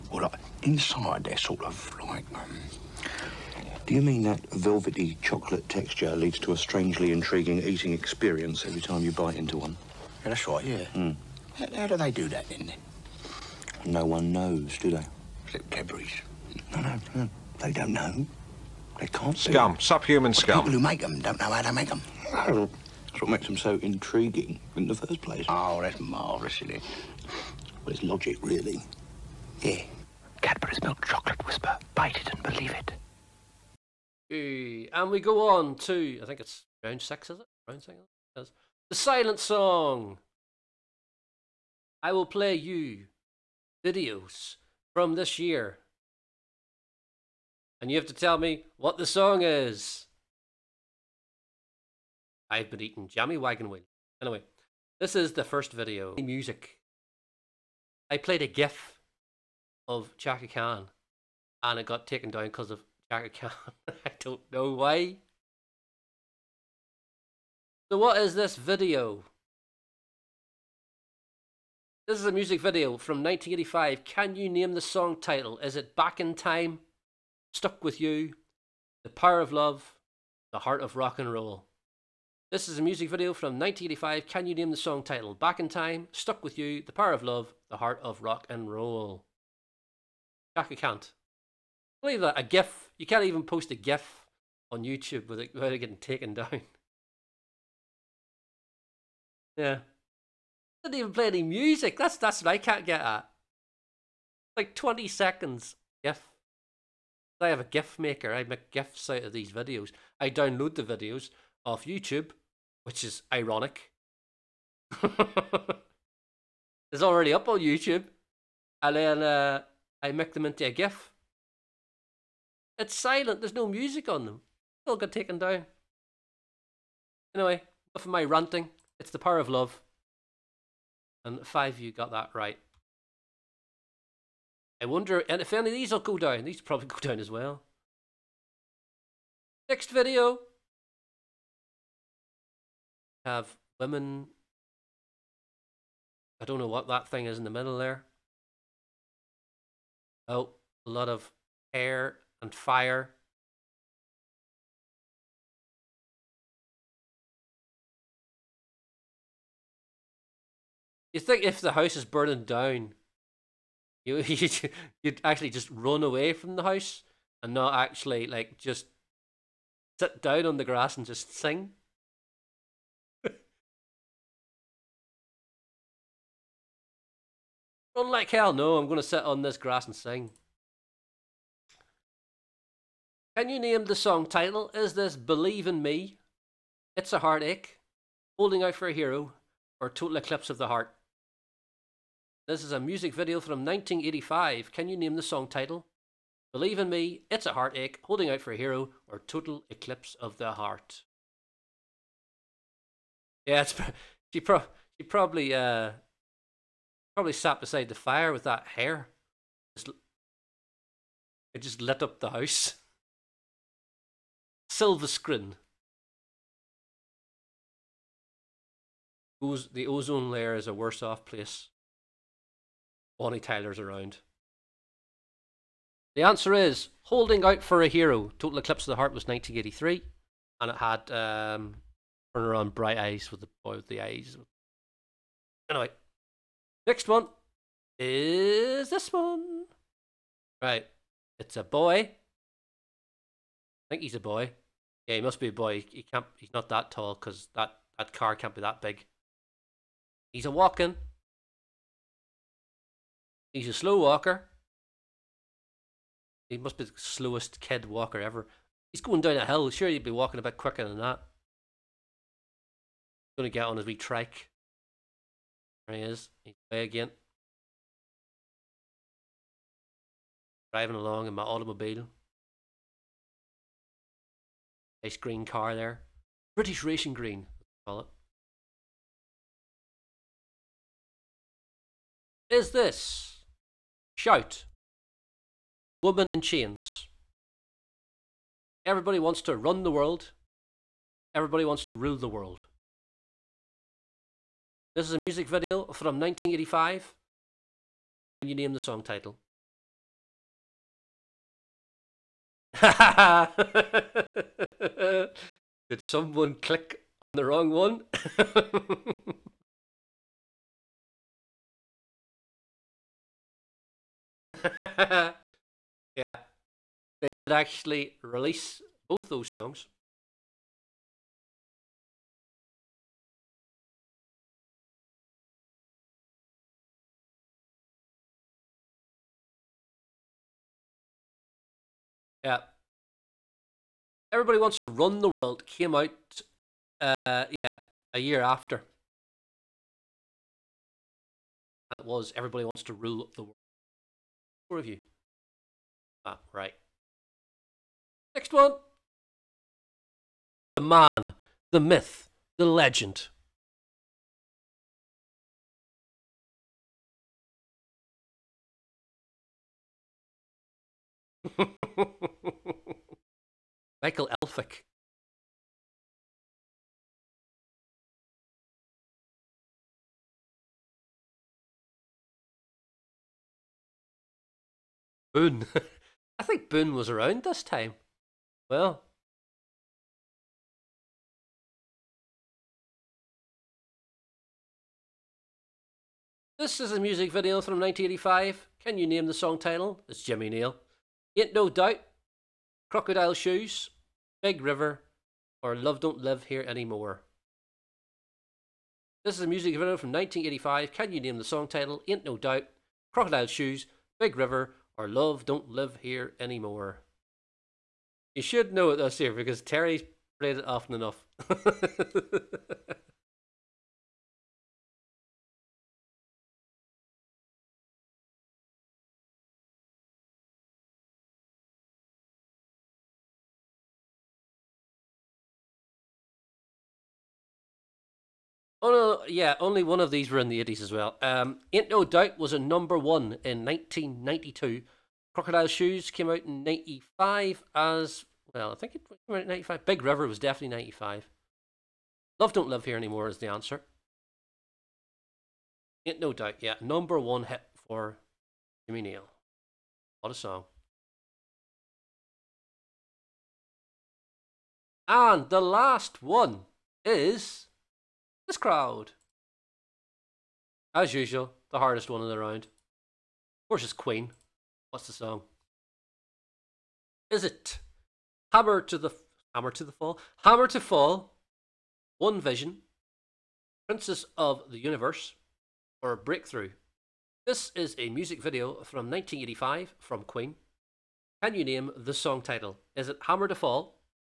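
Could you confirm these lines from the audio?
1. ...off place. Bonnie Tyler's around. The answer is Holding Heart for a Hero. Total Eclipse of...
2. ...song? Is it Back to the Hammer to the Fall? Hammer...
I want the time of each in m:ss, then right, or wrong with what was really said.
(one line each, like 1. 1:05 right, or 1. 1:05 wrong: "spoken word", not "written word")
1. 3:41 wrong: "Out", not "Heart"
2. 7:45 wrong: "Hammer", not "Back".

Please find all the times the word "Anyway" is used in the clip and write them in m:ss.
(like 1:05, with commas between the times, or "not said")
0:54, 2:07, 3:55.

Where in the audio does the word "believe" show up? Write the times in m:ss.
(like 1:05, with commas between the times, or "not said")
0:32, 1:32, 3:05, 3:16.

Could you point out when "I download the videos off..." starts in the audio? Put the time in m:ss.
1:50.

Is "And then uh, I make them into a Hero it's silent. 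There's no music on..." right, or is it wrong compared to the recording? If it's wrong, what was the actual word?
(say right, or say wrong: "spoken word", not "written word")
wrong: "GIF", not "Hero".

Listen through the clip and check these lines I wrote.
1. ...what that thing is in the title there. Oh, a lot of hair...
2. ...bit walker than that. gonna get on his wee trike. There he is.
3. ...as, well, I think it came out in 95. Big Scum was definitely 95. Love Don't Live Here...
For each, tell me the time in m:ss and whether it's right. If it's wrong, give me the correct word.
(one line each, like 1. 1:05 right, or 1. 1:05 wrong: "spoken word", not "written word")
1. 2:26 wrong: "middle", not "title"
2. 4:20 wrong: "quicker", not "walker"
3. 7:17 wrong: "River", not "Scum".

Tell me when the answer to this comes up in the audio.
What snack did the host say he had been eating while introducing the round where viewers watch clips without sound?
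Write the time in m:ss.
0:53.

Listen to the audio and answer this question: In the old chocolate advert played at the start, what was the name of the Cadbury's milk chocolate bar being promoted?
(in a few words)
Wispa.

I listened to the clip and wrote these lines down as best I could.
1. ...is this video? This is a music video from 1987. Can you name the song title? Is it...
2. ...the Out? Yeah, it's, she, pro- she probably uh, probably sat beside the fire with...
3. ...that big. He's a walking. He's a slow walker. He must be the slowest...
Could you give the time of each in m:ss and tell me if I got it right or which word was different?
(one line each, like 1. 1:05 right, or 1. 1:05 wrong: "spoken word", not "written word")
1. 1:08 wrong: "1985", not "1987"
2. 3:20 wrong: "Heart", not "Out"
3. 4:08 right.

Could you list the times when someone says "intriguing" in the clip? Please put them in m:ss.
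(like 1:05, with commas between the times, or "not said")
0:07, 0:23.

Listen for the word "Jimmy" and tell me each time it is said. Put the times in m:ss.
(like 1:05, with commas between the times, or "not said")
6:30, 7:28.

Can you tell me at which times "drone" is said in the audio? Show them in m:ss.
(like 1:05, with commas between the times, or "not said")
not said.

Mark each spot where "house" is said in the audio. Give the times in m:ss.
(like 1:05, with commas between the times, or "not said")
2:41, 2:46, 3:32.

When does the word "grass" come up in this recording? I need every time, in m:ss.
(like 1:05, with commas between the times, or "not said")
2:50, 2:59.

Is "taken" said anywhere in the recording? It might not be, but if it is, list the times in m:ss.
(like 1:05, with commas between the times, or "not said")
1:02, 1:35, 2:05.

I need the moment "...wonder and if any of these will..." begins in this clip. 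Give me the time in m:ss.
2:14.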